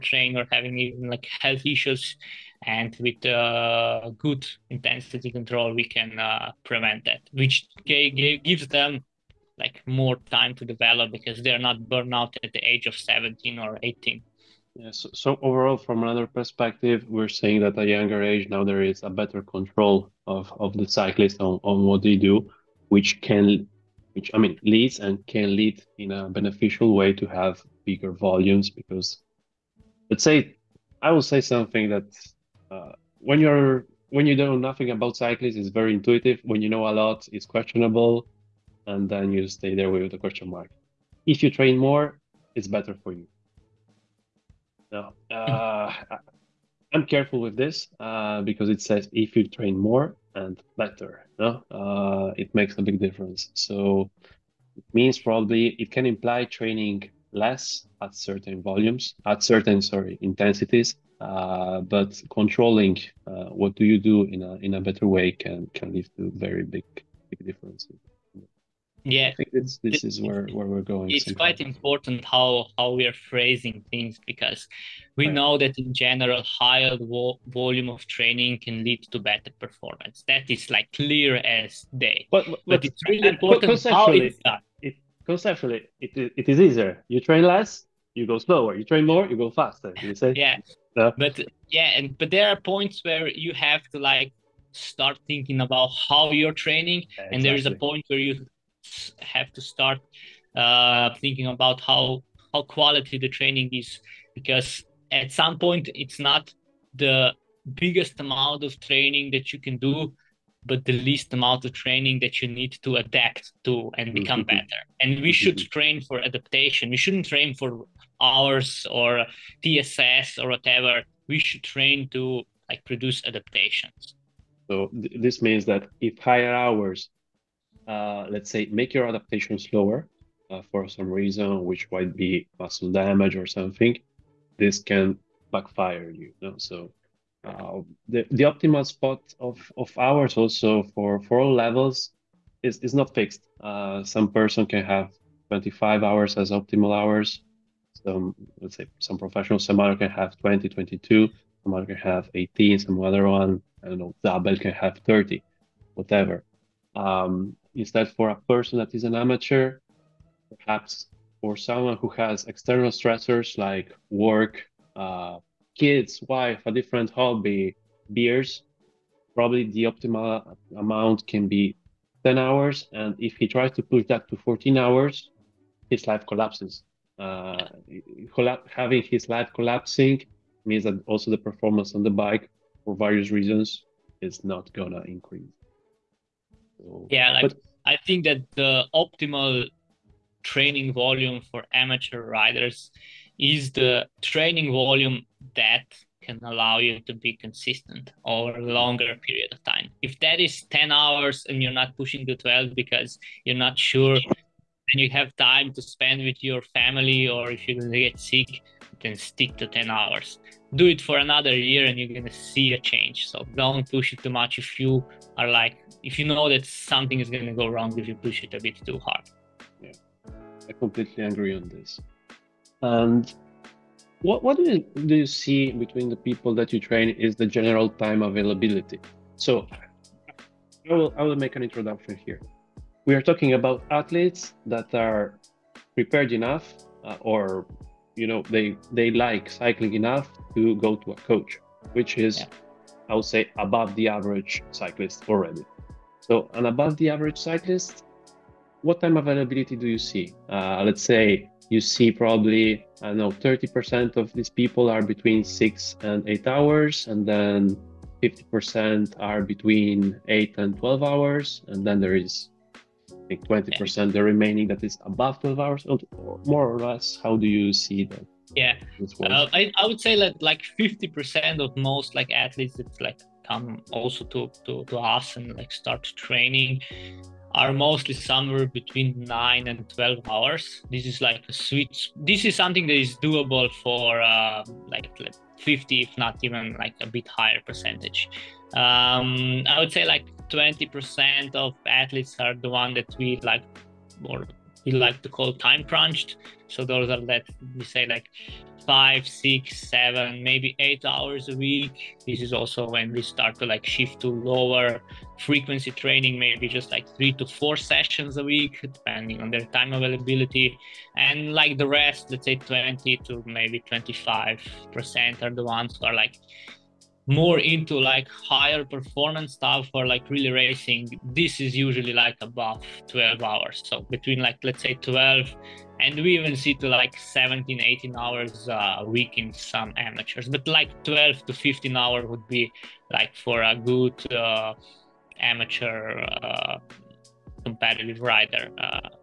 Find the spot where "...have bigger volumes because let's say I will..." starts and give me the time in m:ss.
0:27.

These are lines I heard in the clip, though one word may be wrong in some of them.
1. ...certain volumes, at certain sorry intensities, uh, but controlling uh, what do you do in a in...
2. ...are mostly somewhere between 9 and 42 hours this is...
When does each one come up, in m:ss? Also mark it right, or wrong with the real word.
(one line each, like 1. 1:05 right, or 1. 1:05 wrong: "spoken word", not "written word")
1. 0:58 right
2. 4:37 wrong: "12", not "42".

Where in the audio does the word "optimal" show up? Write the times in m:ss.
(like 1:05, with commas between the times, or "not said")
2:18, 2:26, 2:49, 3:08.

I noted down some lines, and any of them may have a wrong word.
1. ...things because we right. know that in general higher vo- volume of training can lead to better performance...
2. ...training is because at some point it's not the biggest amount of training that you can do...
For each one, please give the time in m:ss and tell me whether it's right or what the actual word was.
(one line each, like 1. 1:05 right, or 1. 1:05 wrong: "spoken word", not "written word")
1. 1:13 right
2. 1:43 right.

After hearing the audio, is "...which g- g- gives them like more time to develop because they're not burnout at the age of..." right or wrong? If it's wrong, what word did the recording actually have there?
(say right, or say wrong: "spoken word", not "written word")
right.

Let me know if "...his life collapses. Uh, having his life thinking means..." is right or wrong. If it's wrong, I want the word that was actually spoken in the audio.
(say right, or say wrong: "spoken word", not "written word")
wrong: "collapsing", not "thinking".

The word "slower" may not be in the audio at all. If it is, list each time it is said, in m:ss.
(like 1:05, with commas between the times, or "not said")
1:28, 2:09.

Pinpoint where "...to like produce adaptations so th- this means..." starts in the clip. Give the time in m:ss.
2:02.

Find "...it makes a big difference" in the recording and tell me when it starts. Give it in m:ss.
0:52.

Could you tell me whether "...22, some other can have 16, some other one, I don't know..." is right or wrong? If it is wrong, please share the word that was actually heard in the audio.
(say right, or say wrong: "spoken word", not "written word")
wrong: "18", not "16".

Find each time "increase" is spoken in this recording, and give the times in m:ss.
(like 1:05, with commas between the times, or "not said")
3:05.